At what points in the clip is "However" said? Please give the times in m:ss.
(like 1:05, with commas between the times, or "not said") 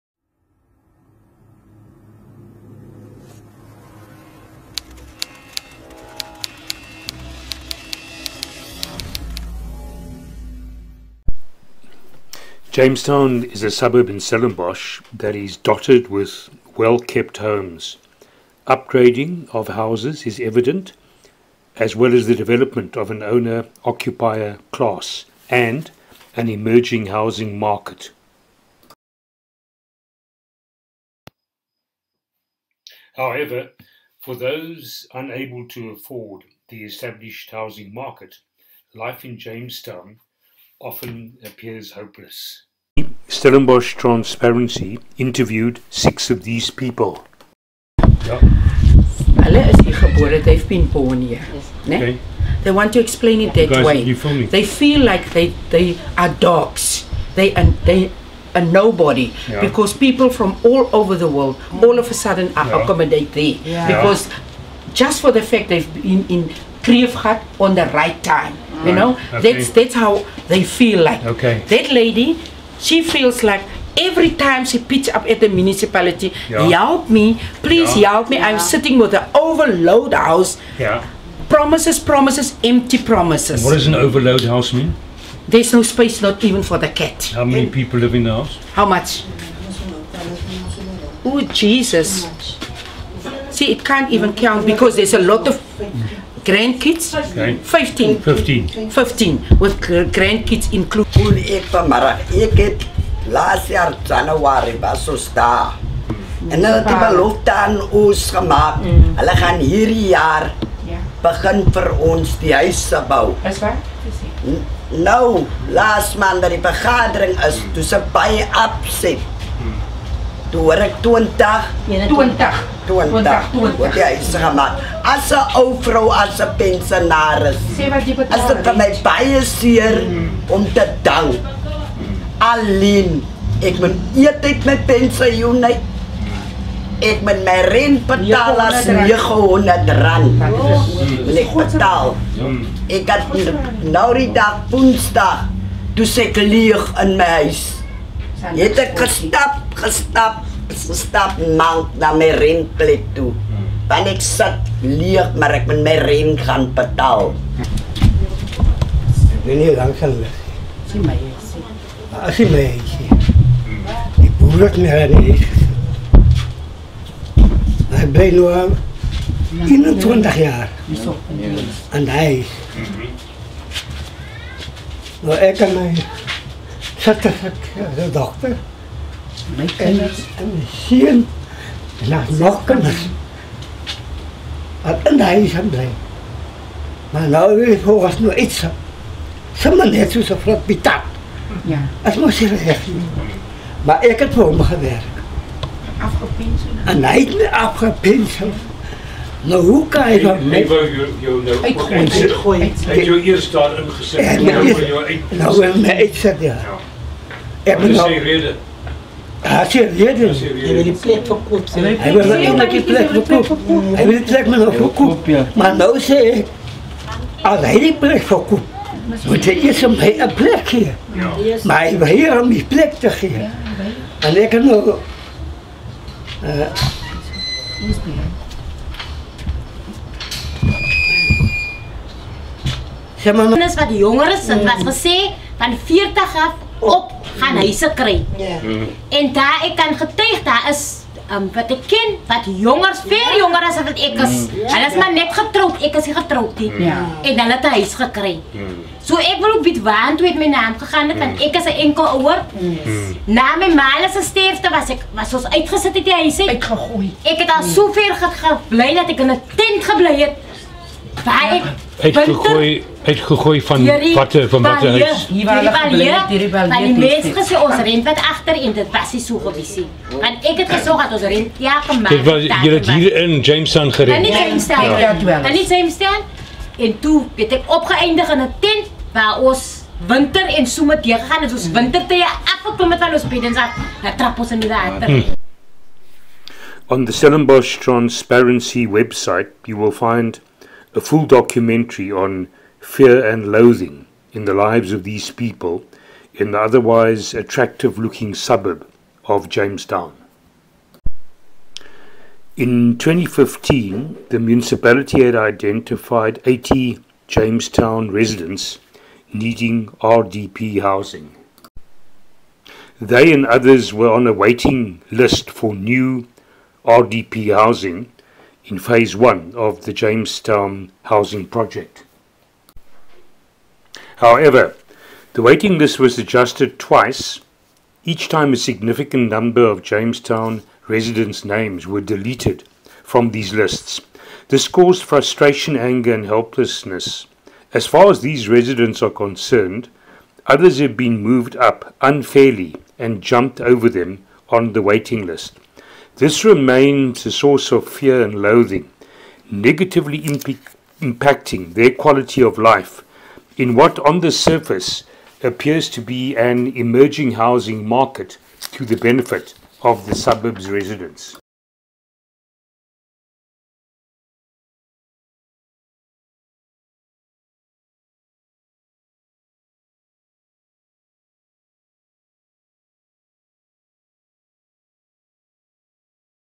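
0:33, 5:24.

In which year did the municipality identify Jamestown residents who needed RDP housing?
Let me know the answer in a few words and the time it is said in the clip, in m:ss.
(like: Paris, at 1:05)
2015, at 5:02.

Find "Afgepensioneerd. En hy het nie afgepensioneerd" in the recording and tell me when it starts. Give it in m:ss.
3:16.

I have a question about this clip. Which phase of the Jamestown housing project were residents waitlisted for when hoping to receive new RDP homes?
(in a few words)
Phase one.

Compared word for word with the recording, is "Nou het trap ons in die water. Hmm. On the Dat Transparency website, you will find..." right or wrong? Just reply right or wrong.
wrong.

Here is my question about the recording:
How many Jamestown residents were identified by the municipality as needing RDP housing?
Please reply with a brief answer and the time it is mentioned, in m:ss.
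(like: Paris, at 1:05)
80, at 5:06.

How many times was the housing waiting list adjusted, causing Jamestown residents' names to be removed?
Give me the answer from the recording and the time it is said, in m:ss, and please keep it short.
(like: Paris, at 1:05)
Twice, at 5:26.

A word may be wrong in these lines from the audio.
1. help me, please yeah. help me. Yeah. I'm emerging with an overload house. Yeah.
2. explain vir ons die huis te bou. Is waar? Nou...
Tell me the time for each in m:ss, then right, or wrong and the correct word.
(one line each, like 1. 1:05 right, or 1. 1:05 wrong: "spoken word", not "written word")
1. 1:16 wrong: "sitting", not "emerging"
2. 1:51 wrong: "begin", not "explain".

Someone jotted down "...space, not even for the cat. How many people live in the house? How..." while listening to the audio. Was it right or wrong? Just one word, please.
right.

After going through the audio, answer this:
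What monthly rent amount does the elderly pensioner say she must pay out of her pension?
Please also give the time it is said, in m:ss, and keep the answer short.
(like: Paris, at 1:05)
900 rand, at 2:18.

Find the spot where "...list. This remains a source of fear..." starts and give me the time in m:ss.
5:45.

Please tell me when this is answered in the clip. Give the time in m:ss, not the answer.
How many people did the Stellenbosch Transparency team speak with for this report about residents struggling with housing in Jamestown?
0:45.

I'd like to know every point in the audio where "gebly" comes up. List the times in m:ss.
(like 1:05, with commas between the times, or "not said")
4:19, 4:25.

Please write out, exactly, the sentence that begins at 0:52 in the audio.
They want to explain it that guys, way.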